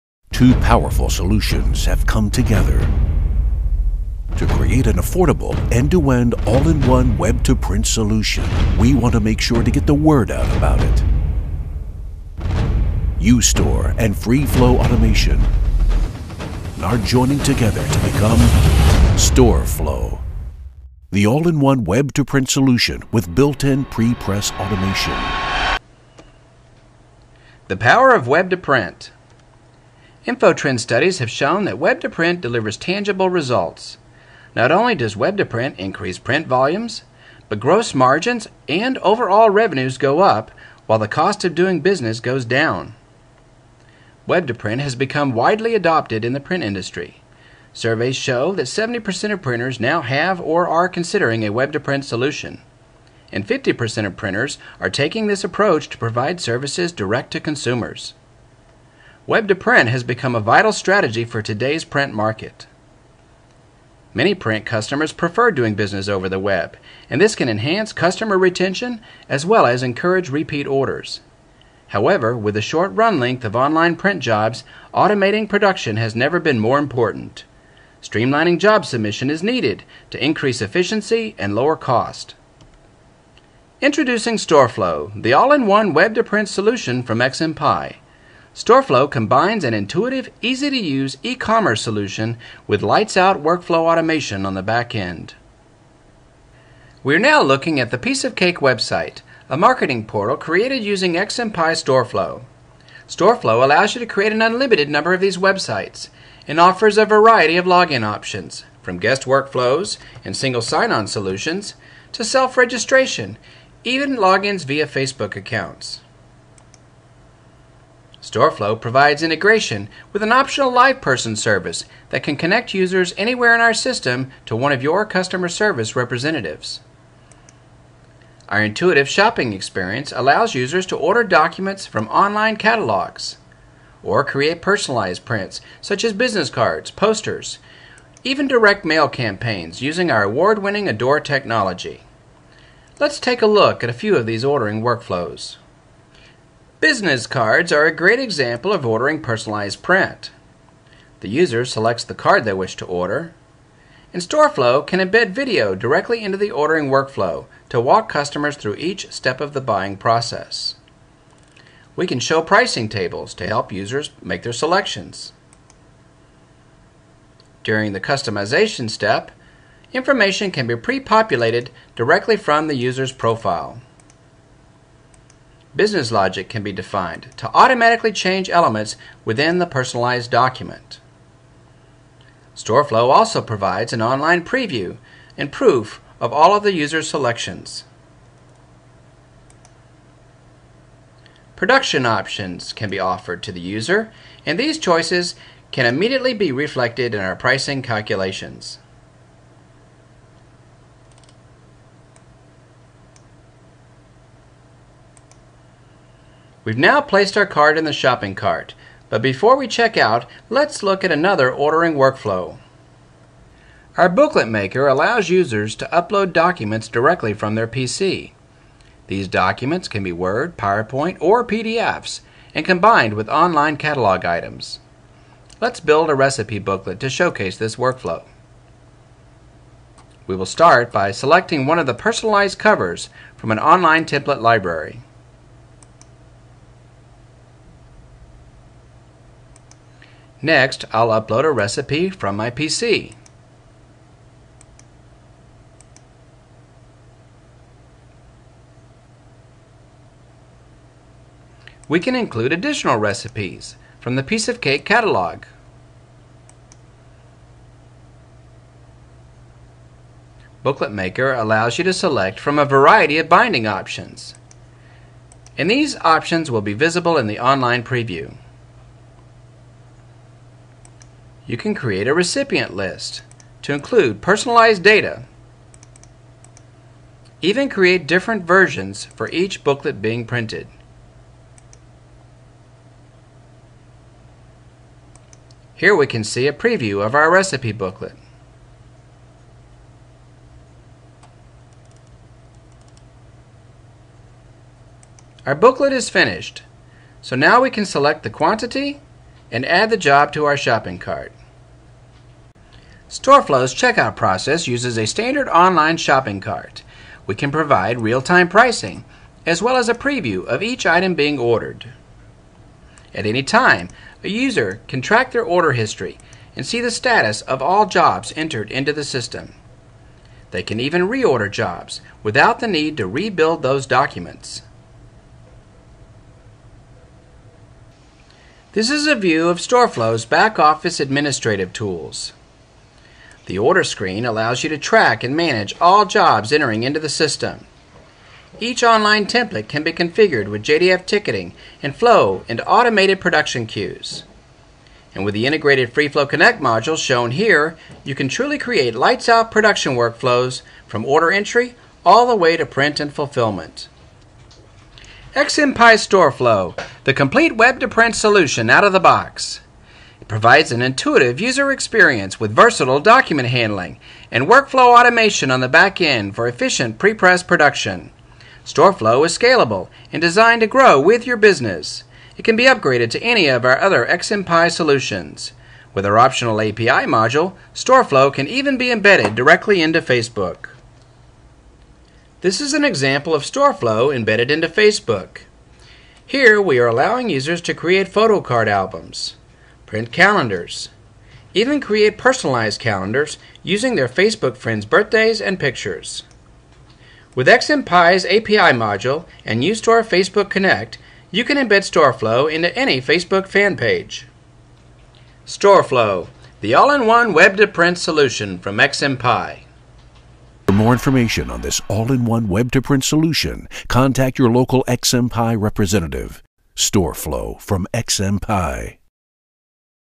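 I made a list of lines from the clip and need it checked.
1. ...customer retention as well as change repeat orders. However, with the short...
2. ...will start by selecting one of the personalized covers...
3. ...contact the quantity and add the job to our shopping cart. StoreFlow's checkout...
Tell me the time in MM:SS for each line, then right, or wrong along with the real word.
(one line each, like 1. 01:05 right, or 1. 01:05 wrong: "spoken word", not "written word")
1. 01:07 wrong: "encourage", not "change"
2. 03:50 right
3. 04:57 wrong: "select", not "contact".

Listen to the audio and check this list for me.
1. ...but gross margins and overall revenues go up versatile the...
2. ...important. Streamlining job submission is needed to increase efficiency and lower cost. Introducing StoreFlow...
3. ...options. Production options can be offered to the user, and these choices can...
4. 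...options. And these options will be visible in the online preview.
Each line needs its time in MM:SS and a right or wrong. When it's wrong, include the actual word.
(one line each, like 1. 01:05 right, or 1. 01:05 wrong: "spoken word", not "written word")
1. 00:37 wrong: "while", not "versatile"
2. 01:16 right
3. 03:07 wrong: "selections", not "options"
4. 04:23 right.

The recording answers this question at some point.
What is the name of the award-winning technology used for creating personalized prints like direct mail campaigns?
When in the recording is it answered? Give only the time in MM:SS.
02:20.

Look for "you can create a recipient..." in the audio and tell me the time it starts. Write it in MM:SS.
04:31.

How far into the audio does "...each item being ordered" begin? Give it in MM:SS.
05:10.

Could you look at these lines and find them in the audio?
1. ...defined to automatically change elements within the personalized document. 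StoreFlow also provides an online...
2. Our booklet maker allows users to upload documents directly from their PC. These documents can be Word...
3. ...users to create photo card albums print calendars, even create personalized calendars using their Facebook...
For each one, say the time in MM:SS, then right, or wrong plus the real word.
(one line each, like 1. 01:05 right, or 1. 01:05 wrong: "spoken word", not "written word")
1. 02:56 right
2. 03:33 right
3. 06:27 right.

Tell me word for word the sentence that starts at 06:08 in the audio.
StoreFlow is scalable and designed to grow with your business.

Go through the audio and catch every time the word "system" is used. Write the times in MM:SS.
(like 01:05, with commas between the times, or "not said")
02:03, 05:19, 05:37.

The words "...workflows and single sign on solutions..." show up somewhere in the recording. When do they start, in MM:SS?
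01:49.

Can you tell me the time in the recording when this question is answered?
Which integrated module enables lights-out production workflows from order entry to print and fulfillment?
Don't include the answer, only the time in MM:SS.
05:45.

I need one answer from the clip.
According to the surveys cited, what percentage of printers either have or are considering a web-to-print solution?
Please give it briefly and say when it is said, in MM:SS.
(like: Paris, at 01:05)
70%, at 00:48.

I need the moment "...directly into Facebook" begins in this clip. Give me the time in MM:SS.
06:19.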